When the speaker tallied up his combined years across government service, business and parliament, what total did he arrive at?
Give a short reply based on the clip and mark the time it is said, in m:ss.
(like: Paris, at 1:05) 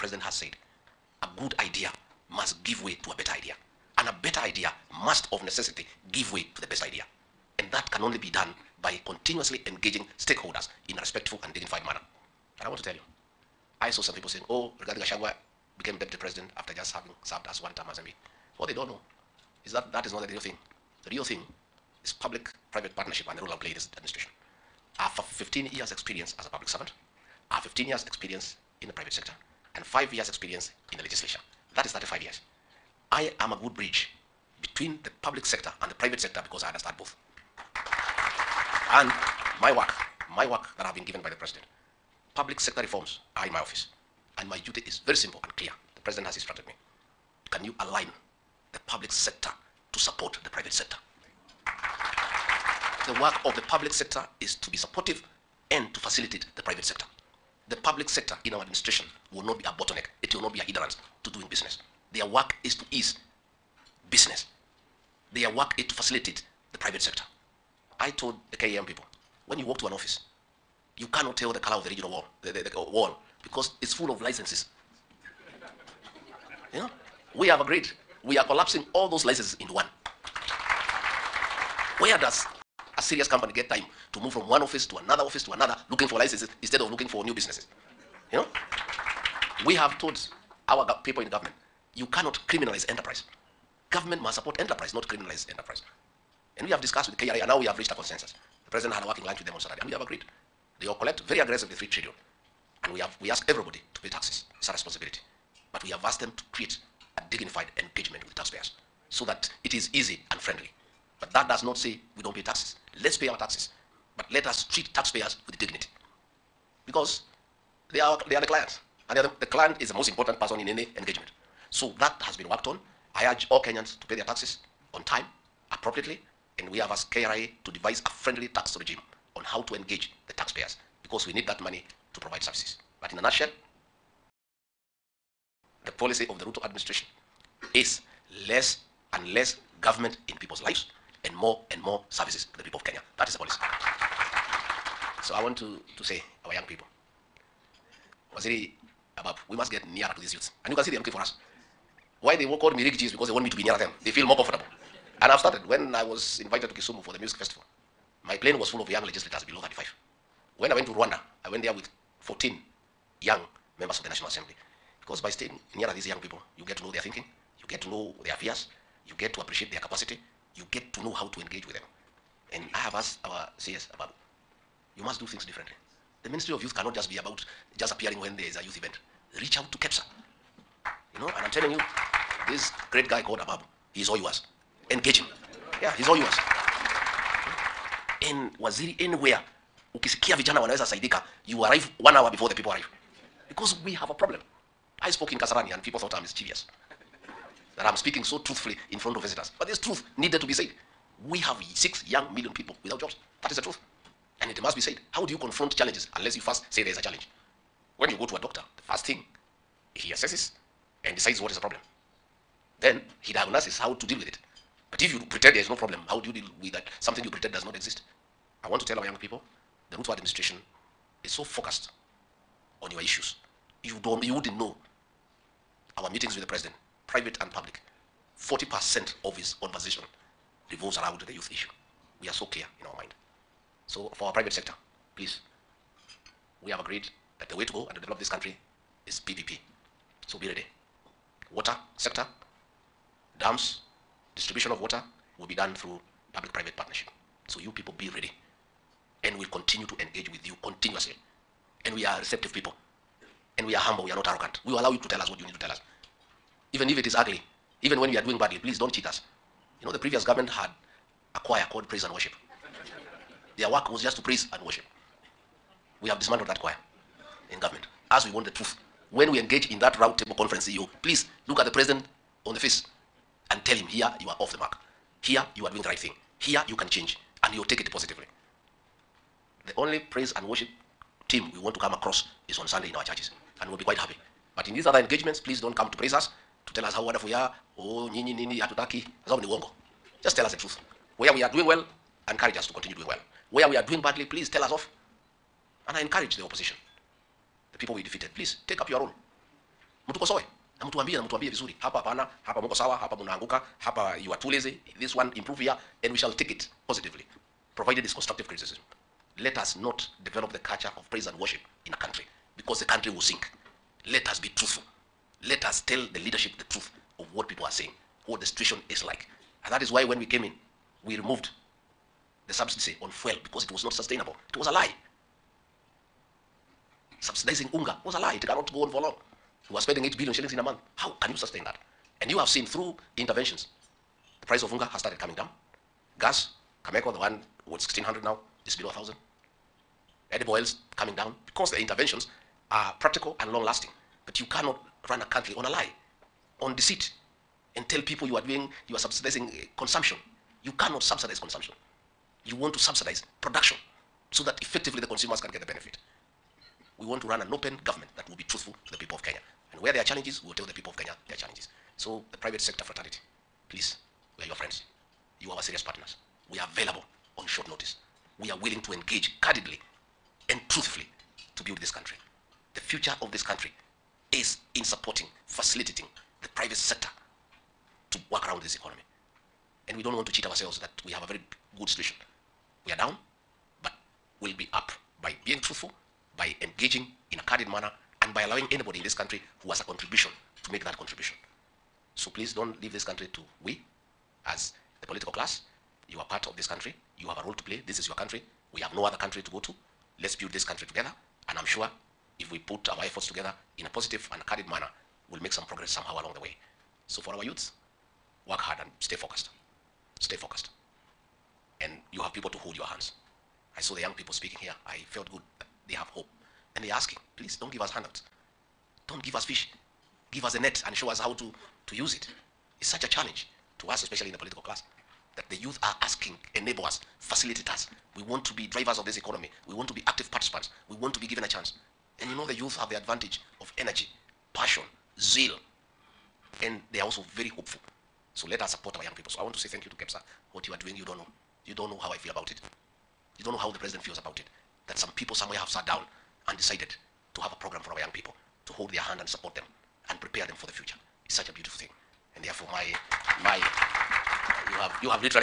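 35 years, at 0:31.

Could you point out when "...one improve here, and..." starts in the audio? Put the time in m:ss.
5:05.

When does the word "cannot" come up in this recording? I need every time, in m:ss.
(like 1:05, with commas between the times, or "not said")
1:11, 1:32, 2:56, 5:28, 5:44, 5:50.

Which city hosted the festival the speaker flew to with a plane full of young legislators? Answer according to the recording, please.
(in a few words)
Kisumu.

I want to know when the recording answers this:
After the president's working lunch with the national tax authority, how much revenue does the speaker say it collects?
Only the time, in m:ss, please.
1:41.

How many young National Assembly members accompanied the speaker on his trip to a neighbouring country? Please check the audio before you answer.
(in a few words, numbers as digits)
14.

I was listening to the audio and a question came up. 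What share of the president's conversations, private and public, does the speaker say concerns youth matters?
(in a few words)
40%.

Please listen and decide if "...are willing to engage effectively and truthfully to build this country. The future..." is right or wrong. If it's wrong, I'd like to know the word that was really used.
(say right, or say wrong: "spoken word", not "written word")
wrong: "candidly", not "effectively".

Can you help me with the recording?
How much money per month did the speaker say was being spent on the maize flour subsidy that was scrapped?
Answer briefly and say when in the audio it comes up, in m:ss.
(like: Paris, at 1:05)
8 billion shillings, at 5:30.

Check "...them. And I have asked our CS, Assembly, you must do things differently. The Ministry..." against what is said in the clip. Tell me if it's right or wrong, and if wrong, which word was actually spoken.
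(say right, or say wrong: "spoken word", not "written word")
wrong: "Ababu", not "Assembly".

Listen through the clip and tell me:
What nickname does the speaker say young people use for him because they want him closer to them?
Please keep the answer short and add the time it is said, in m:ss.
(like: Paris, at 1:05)
Riggy G, at 2:32.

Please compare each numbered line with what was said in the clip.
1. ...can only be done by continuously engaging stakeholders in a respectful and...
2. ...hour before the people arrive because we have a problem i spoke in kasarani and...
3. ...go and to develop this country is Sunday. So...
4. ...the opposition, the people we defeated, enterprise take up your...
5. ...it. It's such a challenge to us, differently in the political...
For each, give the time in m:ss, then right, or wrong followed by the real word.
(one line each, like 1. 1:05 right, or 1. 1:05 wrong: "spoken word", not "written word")
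1. 0:07 right
2. 3:12 right
3. 3:57 wrong: "PPP", not "Sunday"
4. 4:56 wrong: "please", not "enterprise"
5. 7:02 wrong: "especially", not "differently".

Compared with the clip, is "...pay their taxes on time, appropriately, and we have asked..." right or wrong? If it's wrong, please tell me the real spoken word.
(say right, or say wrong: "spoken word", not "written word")
right.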